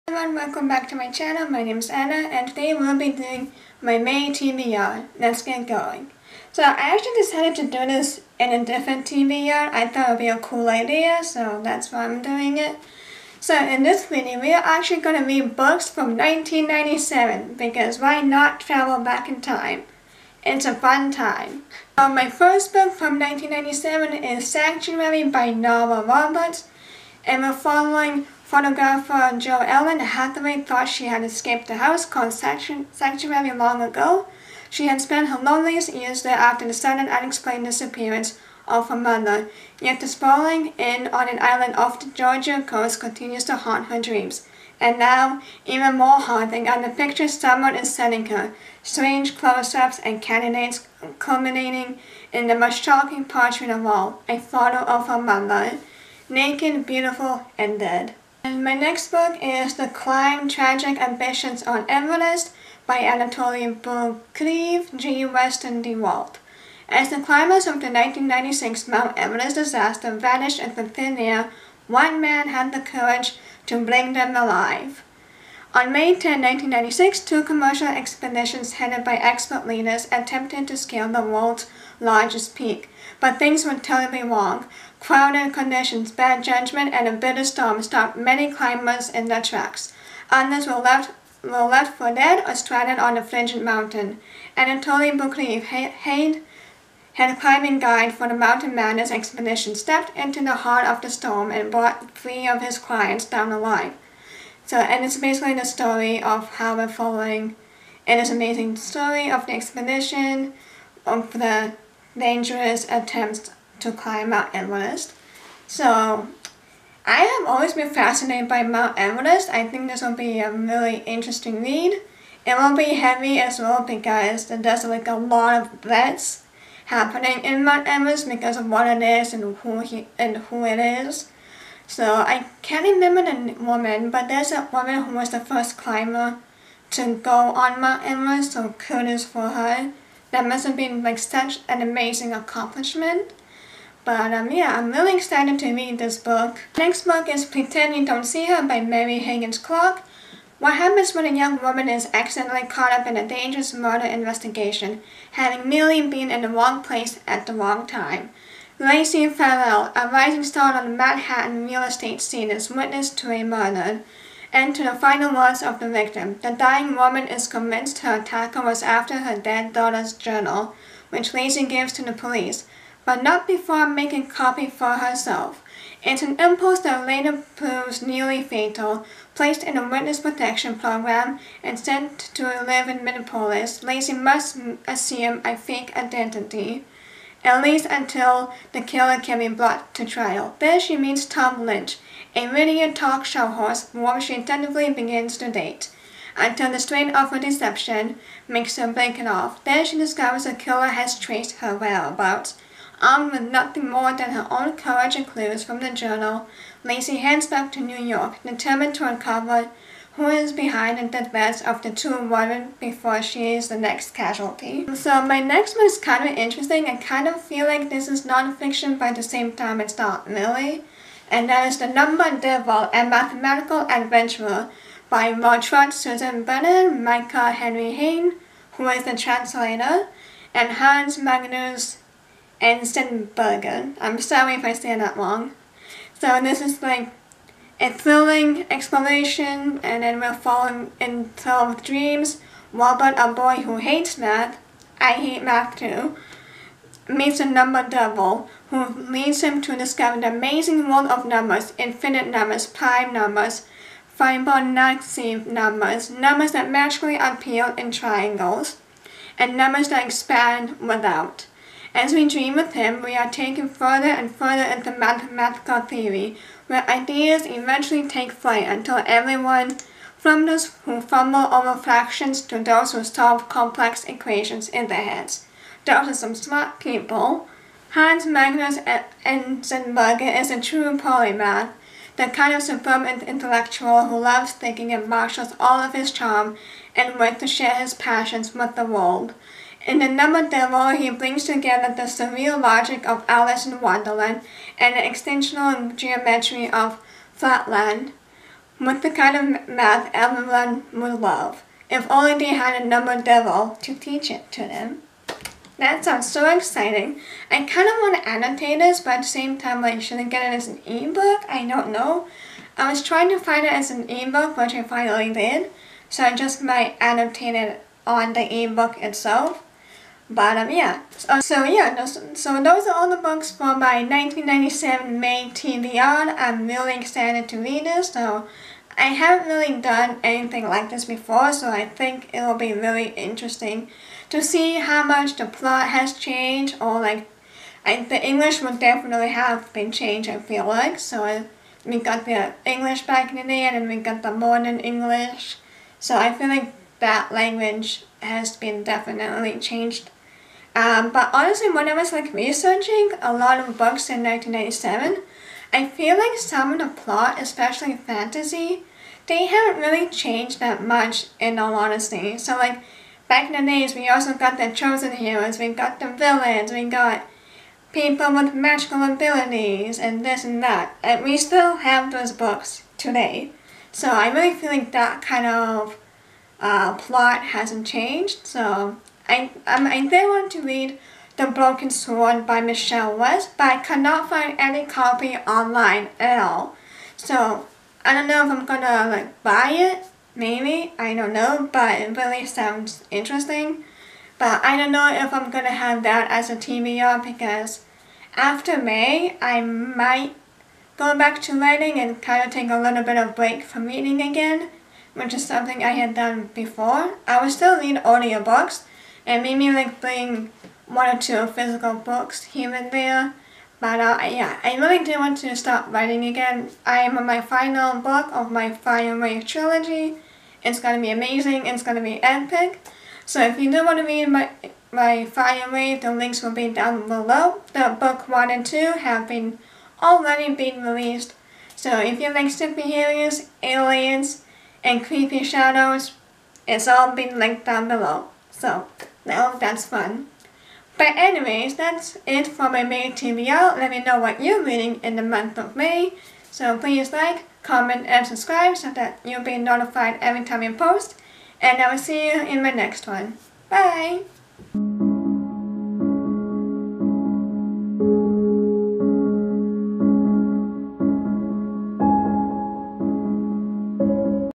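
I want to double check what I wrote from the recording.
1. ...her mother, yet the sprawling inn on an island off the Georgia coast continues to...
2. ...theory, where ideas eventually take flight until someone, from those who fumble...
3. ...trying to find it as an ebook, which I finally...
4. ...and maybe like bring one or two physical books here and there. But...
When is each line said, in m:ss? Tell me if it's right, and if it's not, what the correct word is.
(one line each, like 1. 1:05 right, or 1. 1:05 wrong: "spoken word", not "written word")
1. 0:38 right
2. 4:25 wrong: "everyone", not "someone"
3. 5:13 right
4. 6:49 right.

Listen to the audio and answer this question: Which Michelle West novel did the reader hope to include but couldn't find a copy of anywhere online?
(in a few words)
The Broken Sword.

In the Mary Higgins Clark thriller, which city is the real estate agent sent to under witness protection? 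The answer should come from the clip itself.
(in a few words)
Minneapolis.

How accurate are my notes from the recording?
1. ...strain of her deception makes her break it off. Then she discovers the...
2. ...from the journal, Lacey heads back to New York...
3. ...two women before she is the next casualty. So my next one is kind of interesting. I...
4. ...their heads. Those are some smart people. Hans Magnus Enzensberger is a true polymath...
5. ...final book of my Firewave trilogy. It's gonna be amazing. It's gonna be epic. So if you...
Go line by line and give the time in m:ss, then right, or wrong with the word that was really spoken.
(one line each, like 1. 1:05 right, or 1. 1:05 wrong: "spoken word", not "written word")
1. 3:16 right
2. 3:25 right
3. 3:31 right
4. 4:34 right
5. 6:57 right.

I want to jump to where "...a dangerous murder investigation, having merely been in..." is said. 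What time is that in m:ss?
2:33.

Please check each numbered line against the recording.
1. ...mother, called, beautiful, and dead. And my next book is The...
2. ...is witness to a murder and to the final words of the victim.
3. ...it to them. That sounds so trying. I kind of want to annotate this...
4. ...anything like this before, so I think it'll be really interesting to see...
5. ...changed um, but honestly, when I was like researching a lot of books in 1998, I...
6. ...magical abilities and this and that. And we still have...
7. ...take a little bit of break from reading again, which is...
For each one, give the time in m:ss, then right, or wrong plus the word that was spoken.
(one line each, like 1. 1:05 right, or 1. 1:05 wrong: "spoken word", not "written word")
1. 0:55 wrong: "naked", not "called"
2. 2:42 right
3. 5:04 wrong: "exciting", not "trying"
4. 5:30 right
5. 5:49 wrong: "1997", not "1998"
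6. 6:08 right
7. 6:42 right.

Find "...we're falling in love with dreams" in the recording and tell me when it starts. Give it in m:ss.
4:00.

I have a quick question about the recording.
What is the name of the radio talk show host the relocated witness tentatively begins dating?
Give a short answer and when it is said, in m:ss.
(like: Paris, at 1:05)
Tom Lynch, at 3:11.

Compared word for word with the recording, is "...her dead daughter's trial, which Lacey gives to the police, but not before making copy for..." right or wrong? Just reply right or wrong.
wrong.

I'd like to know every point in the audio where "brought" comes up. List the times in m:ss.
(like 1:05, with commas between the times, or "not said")
1:41, 3:09.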